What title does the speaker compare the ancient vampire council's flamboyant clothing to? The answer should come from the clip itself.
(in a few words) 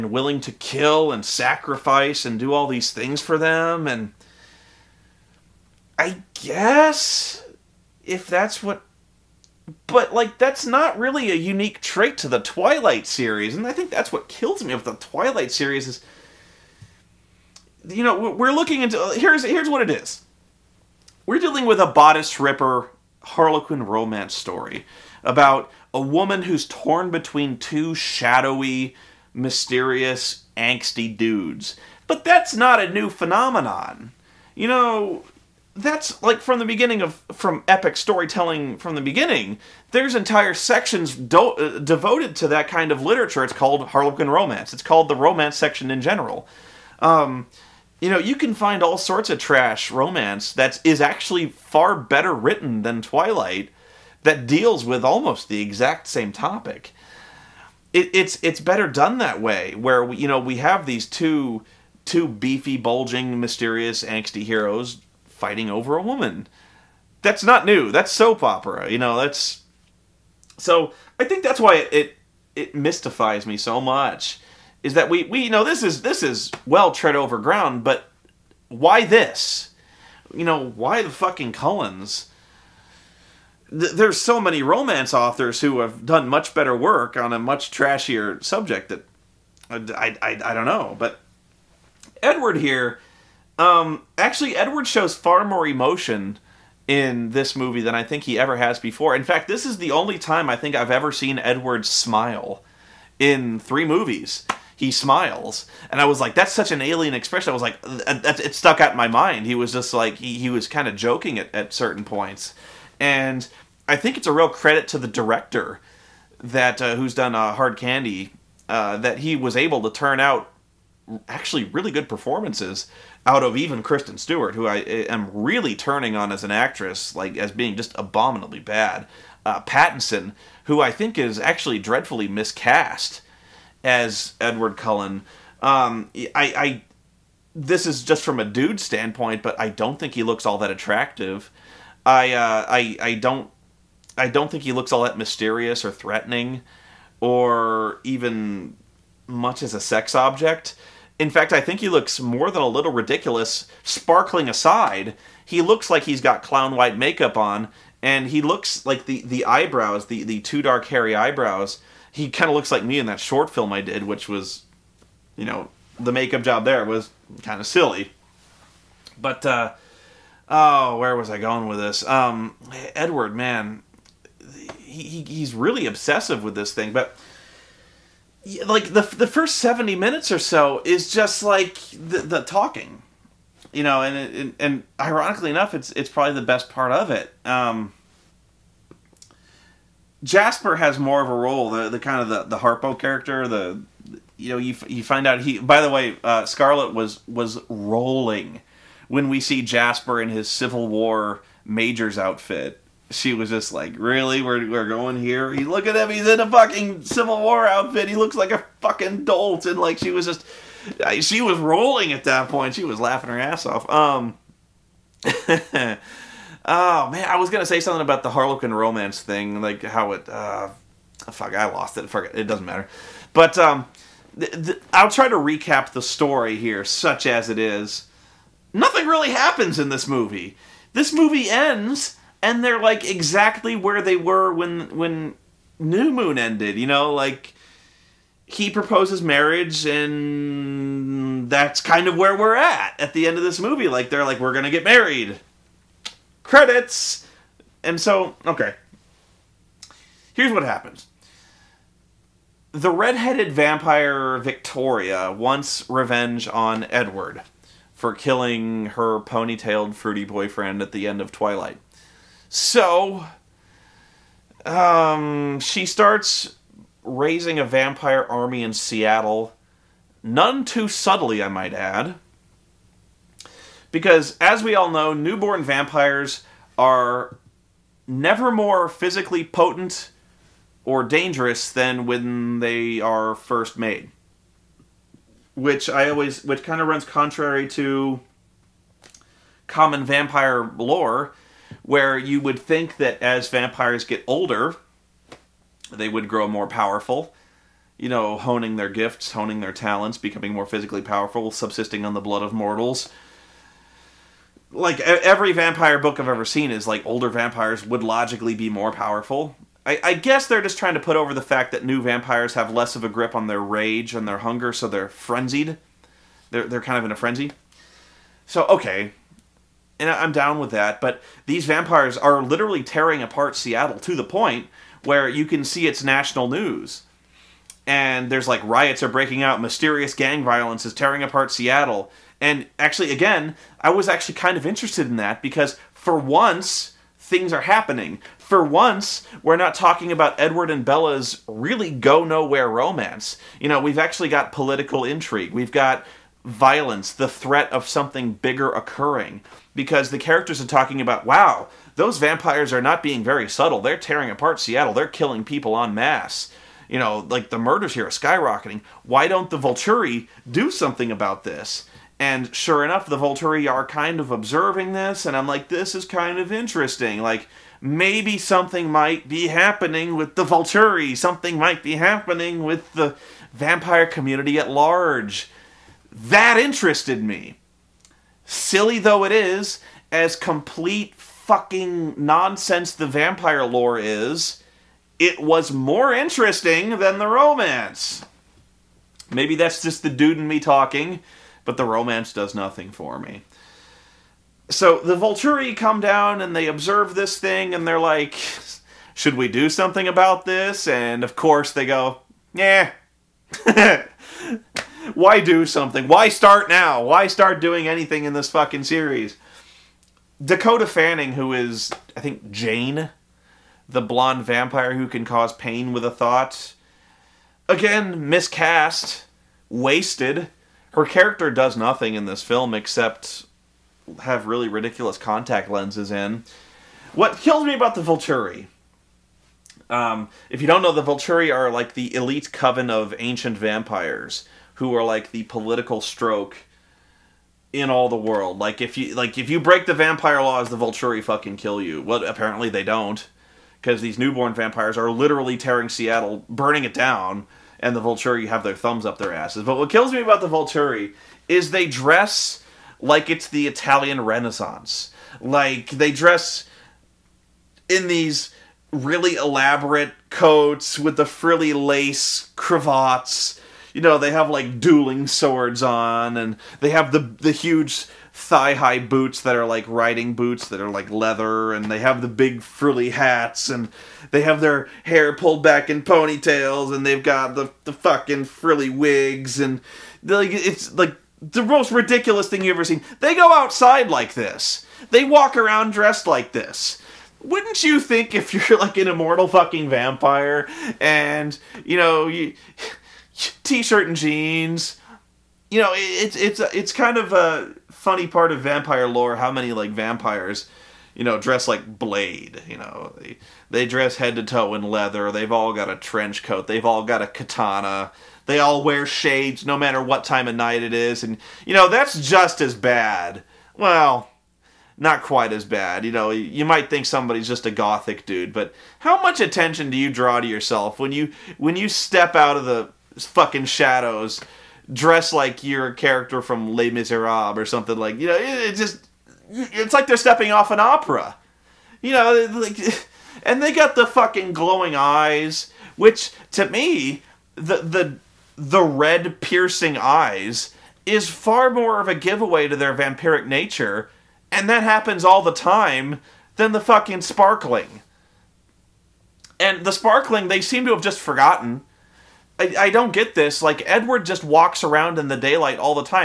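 Les Miserables.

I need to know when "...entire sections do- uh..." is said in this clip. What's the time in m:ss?
0:40.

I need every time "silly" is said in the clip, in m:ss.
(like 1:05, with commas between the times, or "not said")
2:47, 6:18.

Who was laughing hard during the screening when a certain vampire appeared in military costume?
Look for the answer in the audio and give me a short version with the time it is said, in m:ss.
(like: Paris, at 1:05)
Scarlet, at 3:16.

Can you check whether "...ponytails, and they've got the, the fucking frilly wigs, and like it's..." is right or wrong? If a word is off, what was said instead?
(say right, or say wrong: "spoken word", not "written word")
right.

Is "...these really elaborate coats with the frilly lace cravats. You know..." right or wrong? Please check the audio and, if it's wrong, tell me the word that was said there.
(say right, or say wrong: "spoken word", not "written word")
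right.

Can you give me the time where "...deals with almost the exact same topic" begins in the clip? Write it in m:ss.
0:54.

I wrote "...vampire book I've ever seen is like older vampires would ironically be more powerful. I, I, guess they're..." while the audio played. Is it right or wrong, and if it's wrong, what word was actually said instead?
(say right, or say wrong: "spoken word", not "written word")
wrong: "logically", not "ironically".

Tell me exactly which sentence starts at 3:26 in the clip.
He's in a fucking Civil War outfit.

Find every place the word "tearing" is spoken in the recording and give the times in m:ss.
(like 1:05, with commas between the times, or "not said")
5:22, 5:30, 5:53, 7:25.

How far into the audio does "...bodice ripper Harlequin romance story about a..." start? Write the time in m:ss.
0:21.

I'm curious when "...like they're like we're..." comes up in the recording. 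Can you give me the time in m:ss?
4:03.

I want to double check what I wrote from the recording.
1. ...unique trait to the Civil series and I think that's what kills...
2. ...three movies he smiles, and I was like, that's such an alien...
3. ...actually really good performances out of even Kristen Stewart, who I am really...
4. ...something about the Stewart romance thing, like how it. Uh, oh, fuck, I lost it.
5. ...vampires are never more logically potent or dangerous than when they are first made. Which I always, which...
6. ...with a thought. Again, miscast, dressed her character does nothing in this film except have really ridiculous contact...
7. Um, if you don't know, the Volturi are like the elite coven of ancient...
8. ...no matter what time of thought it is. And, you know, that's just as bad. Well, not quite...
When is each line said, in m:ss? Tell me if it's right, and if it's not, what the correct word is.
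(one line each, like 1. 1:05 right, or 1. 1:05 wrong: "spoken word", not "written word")
1. 0:11 wrong: "Twilight", not "Civil"
2. 1:43 right
3. 2:01 right
4. 3:37 wrong: "Harlequin", not "Stewart"
5. 4:35 wrong: "physically", not "logically"
6. 6:55 wrong: "wasted", not "dressed"
7. 7:09 right
8. 8:29 wrong: "night", not "thought".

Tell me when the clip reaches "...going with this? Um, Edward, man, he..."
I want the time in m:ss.
2:51.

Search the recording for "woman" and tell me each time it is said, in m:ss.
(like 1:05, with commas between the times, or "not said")
0:25, 1:06.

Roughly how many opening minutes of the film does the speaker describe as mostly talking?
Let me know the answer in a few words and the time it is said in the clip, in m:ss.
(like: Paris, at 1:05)
70, at 2:59.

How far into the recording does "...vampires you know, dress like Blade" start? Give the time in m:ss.
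8:19.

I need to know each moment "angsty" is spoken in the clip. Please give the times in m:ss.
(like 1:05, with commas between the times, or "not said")
0:30, 1:04.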